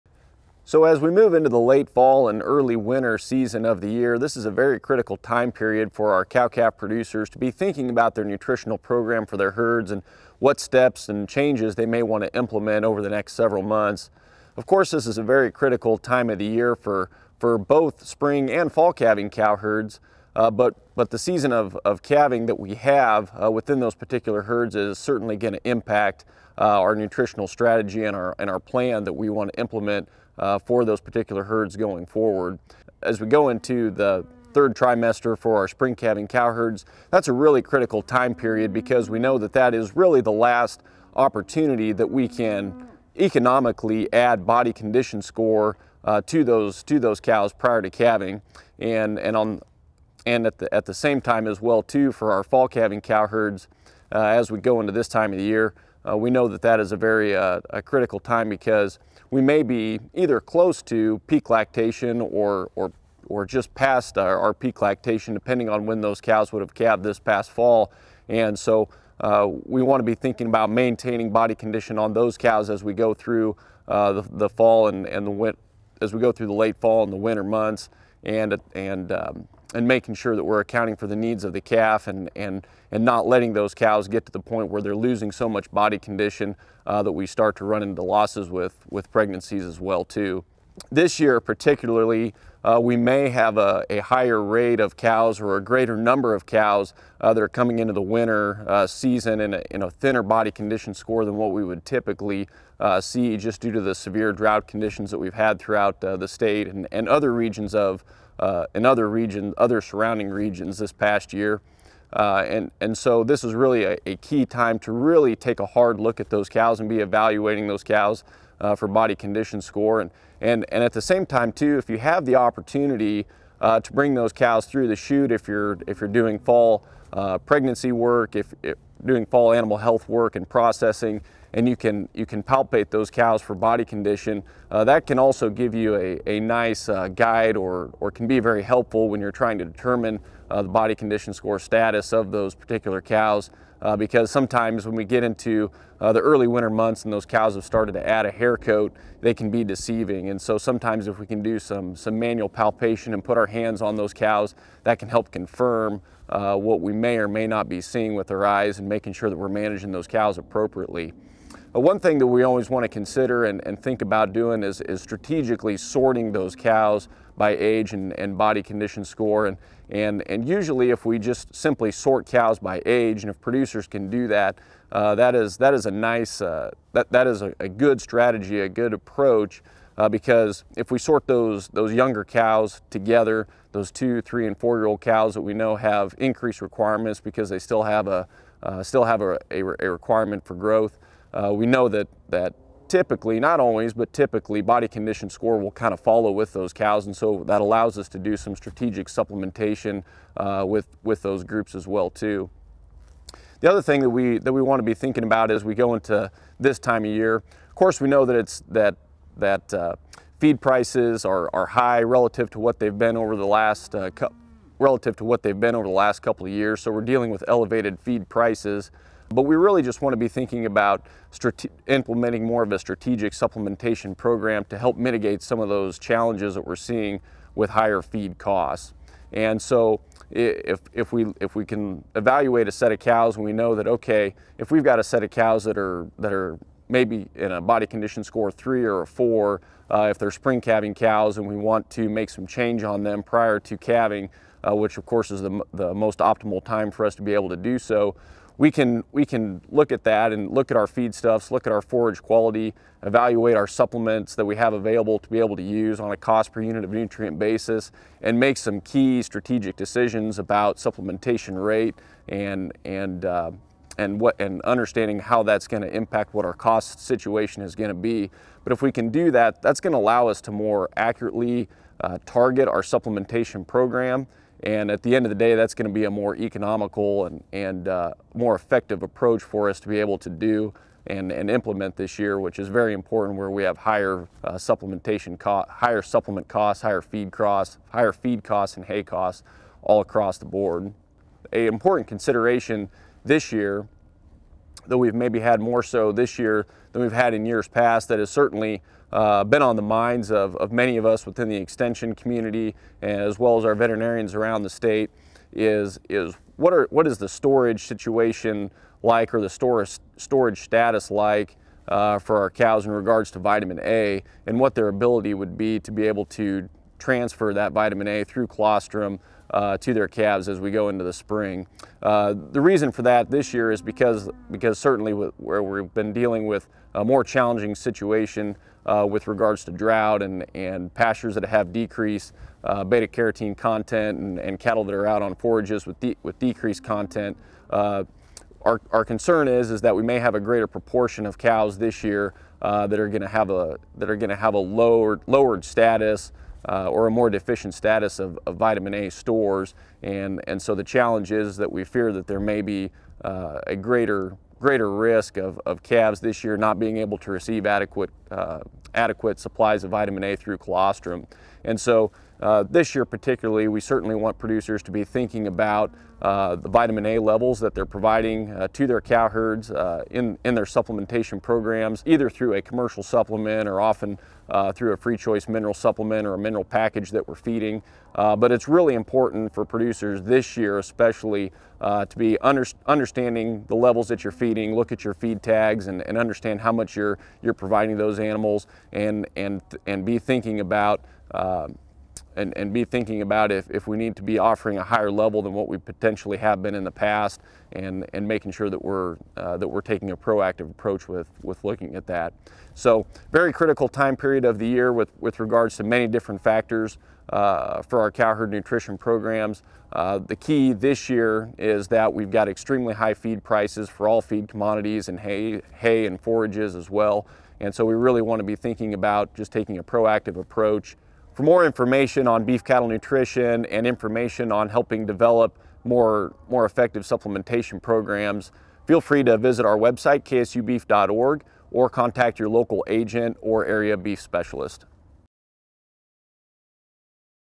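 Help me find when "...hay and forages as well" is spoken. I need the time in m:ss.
6:55.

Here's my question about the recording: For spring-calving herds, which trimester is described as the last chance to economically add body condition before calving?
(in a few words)
third trimester.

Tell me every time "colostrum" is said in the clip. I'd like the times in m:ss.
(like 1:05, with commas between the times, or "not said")
5:18, 6:00.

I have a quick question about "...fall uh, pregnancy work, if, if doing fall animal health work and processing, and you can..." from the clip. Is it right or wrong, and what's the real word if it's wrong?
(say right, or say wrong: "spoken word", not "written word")
right.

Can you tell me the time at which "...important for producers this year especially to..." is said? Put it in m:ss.
6:18.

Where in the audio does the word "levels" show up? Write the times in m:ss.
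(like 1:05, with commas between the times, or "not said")
6:07, 6:23, 6:35.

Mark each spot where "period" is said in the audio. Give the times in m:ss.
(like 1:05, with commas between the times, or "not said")
0:05, 0:38, 6:44.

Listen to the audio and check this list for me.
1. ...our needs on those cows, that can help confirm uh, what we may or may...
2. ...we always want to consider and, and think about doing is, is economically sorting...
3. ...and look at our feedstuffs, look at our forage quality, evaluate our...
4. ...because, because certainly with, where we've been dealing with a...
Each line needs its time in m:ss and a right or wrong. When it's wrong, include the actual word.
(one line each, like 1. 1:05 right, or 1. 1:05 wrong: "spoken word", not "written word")
1. 2:33 wrong: "hands", not "needs"
2. 2:42 wrong: "strategically", not "economically"
3. 4:10 right
4. 5:23 right.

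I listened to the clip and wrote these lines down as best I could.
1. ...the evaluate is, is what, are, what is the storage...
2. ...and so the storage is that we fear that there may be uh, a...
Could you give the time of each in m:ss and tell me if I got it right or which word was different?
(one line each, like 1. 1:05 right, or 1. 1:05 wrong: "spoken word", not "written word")
1. 5:04 wrong: "state", not "evaluate"
2. 5:50 wrong: "challenge", not "storage".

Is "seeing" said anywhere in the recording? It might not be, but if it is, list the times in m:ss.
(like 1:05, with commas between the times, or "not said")
2:37, 3:46.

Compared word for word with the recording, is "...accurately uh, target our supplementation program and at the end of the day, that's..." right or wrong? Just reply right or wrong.
right.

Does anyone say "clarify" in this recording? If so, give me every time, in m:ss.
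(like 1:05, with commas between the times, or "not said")
not said.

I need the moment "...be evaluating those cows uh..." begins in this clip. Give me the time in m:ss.
1:56.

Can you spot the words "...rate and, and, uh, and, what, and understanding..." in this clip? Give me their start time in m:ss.
4:21.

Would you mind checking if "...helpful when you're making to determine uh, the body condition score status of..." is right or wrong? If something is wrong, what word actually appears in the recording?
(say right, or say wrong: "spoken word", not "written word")
wrong: "trying", not "making".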